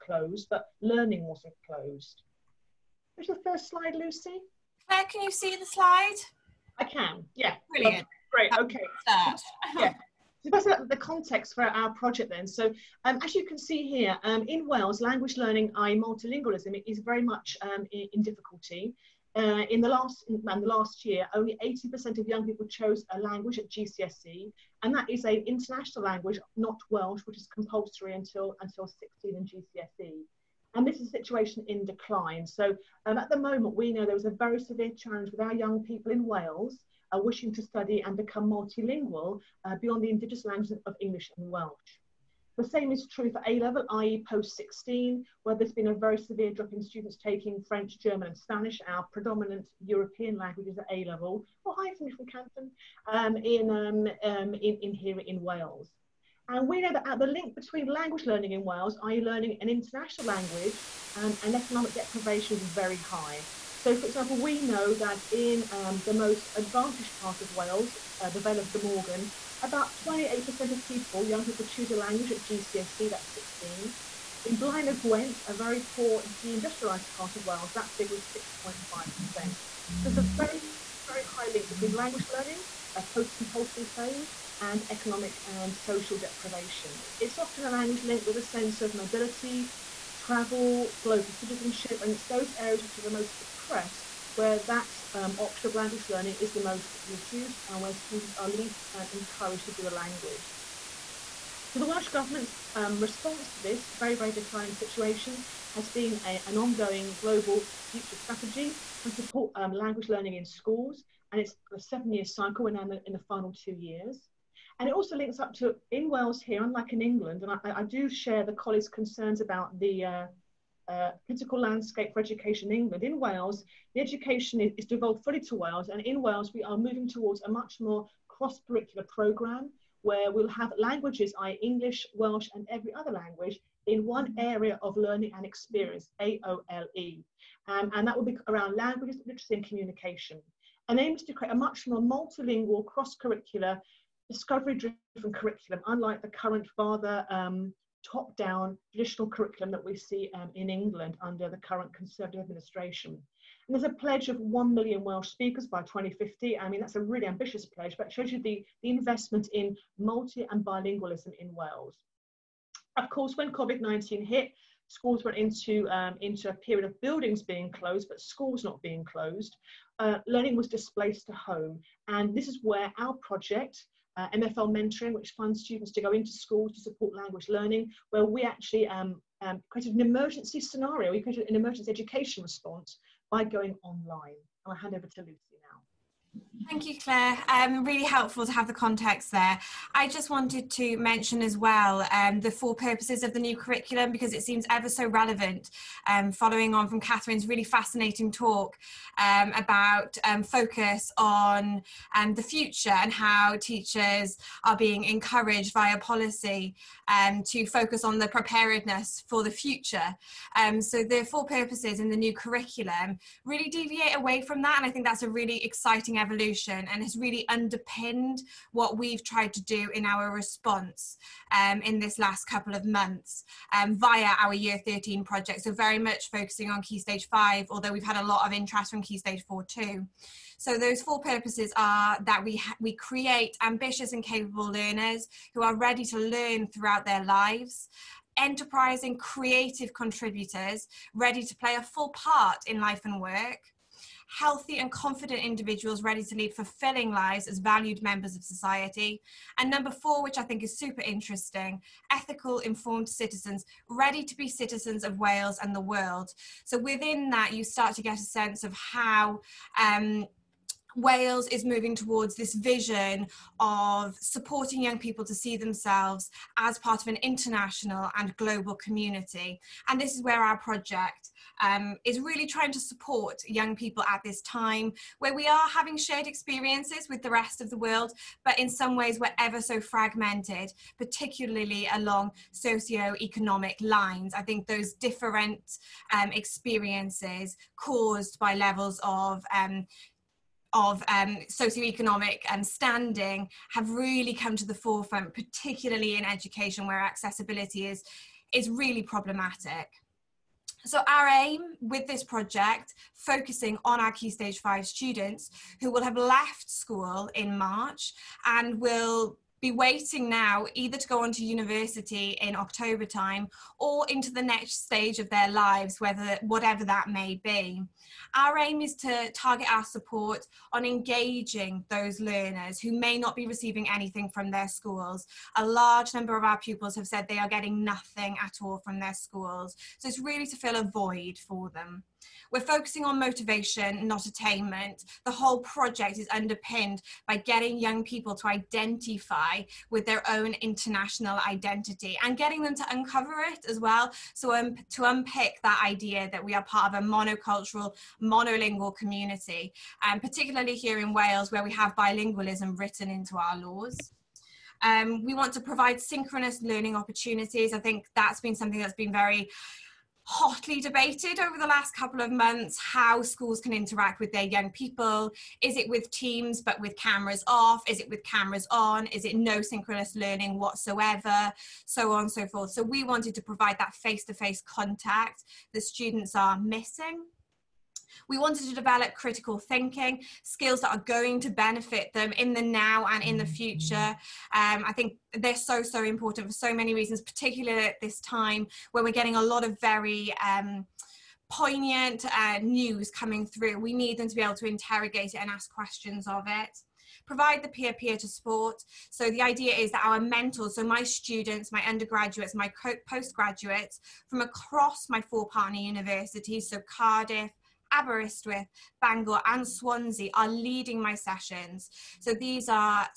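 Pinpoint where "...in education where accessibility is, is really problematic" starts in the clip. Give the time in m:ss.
4:56.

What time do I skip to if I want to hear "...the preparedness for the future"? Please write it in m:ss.
3:28.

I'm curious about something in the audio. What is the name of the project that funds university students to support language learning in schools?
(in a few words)
MFL mentoring.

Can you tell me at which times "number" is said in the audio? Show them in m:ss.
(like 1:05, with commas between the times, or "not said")
4:09, 5:26.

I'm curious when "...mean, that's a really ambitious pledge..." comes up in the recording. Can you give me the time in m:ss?
2:36.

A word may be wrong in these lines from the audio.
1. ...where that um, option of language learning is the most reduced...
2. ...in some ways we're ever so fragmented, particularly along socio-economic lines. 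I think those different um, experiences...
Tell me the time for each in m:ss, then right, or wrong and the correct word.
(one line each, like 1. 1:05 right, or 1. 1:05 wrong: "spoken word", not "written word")
1. 1:34 right
2. 4:38 right.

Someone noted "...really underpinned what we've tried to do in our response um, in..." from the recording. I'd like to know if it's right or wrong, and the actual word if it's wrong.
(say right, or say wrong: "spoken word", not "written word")
right.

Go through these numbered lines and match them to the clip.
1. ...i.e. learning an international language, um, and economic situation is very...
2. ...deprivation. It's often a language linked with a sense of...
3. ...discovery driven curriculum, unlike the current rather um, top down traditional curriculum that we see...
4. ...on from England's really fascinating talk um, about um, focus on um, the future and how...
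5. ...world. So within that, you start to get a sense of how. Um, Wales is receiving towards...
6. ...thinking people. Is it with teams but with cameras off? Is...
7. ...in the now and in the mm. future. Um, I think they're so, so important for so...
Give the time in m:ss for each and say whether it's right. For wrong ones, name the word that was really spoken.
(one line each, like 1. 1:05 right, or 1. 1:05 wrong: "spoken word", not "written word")
1. 0:59 wrong: "deprivation", not "situation"
2. 1:26 right
3. 2:24 right
4. 3:16 wrong: "Catherine", not "England"
5. 4:15 wrong: "moving", not "receiving"
6. 6:04 wrong: "young", not "thinking"
7. 6:22 right.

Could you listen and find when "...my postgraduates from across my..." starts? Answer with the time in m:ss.
6:42.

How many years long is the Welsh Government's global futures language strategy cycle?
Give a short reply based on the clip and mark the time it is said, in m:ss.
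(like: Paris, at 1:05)
7, at 1:51.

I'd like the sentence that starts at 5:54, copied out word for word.
Um, we want to provide synchronous learning opportunities.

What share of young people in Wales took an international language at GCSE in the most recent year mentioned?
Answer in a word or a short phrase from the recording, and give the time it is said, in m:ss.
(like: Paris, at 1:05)
80%, at 0:21.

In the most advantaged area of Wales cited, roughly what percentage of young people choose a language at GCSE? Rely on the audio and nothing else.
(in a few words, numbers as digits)
28%.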